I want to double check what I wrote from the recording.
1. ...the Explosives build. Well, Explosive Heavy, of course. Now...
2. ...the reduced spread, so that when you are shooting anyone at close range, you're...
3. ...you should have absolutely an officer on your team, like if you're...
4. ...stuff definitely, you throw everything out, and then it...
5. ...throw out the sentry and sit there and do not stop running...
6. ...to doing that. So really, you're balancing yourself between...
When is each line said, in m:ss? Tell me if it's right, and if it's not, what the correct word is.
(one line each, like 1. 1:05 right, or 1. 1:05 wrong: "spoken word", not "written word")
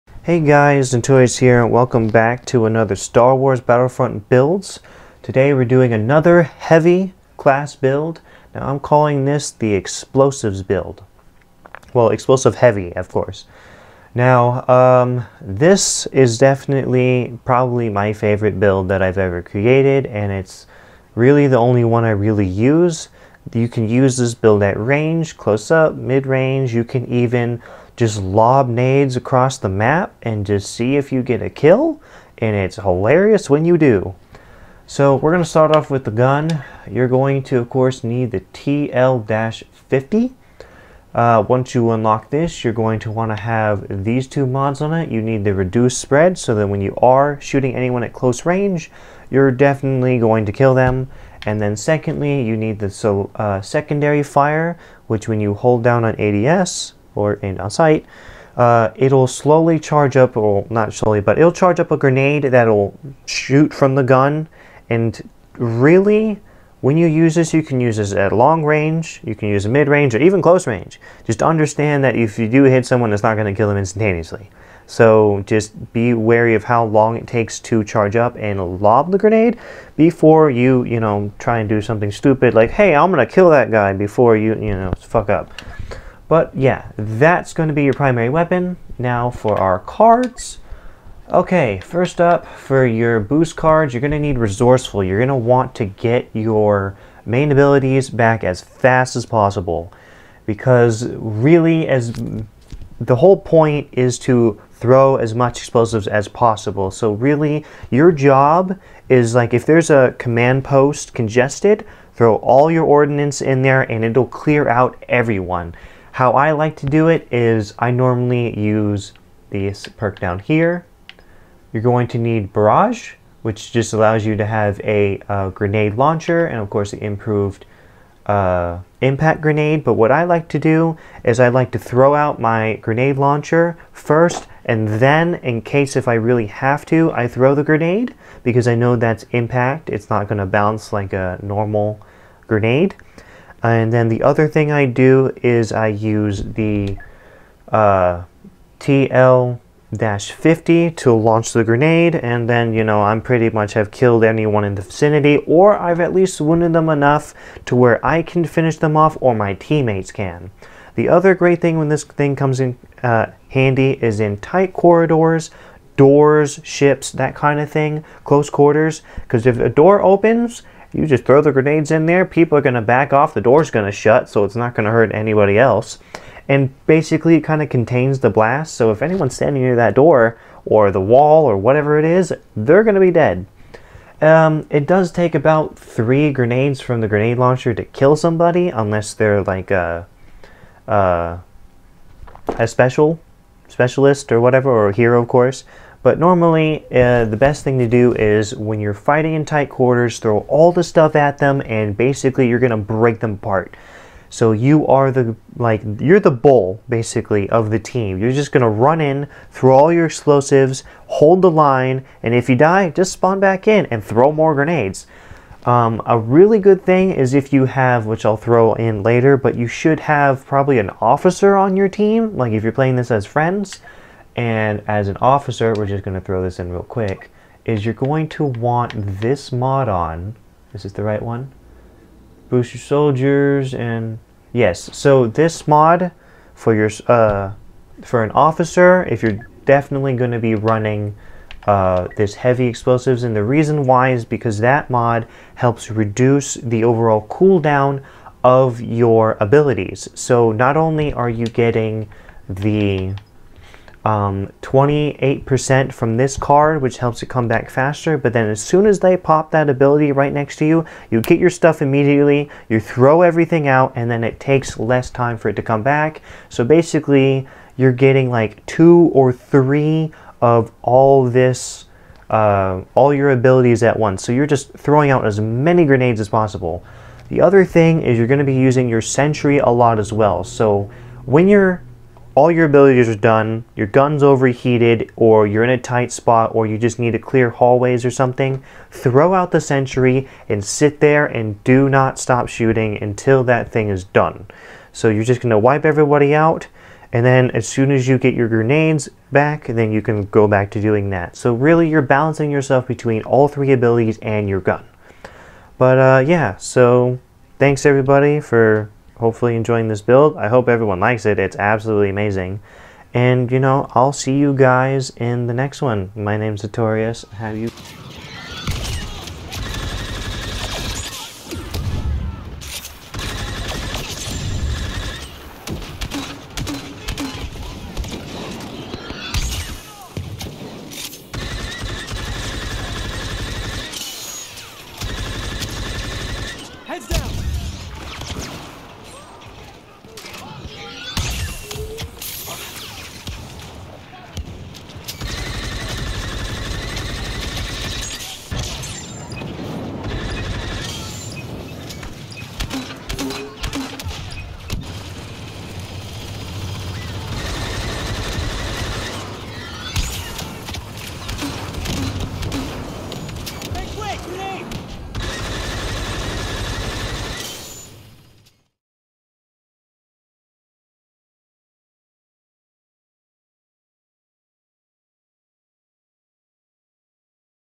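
1. 0:09 right
2. 0:45 right
3. 3:39 wrong: "probably", not "absolutely"
4. 4:21 wrong: "immediately", not "definitely"
5. 4:48 wrong: "shooting", not "running"
6. 5:00 right.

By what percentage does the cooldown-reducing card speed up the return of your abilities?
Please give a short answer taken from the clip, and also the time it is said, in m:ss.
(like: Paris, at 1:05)
28%, at 4:14.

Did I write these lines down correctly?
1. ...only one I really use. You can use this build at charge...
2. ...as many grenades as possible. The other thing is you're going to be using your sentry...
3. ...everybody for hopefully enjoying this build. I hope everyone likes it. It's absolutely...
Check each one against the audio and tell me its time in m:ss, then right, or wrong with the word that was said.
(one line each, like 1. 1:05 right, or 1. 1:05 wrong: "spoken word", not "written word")
1. 0:21 wrong: "range", not "charge"
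2. 4:35 right
3. 5:07 right.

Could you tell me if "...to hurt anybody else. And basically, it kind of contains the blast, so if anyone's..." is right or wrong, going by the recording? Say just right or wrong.
right.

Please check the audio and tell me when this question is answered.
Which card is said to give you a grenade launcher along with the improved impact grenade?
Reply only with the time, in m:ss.
2:02.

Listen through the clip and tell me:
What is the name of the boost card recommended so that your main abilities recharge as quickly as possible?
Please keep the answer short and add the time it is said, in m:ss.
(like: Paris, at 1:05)
Resourceful, at 1:34.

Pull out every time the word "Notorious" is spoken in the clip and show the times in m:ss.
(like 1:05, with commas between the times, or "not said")
0:00, 5:16.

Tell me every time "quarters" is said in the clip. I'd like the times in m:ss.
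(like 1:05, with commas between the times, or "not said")
2:48, 3:19.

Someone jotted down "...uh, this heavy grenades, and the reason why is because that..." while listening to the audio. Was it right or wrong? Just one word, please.
wrong.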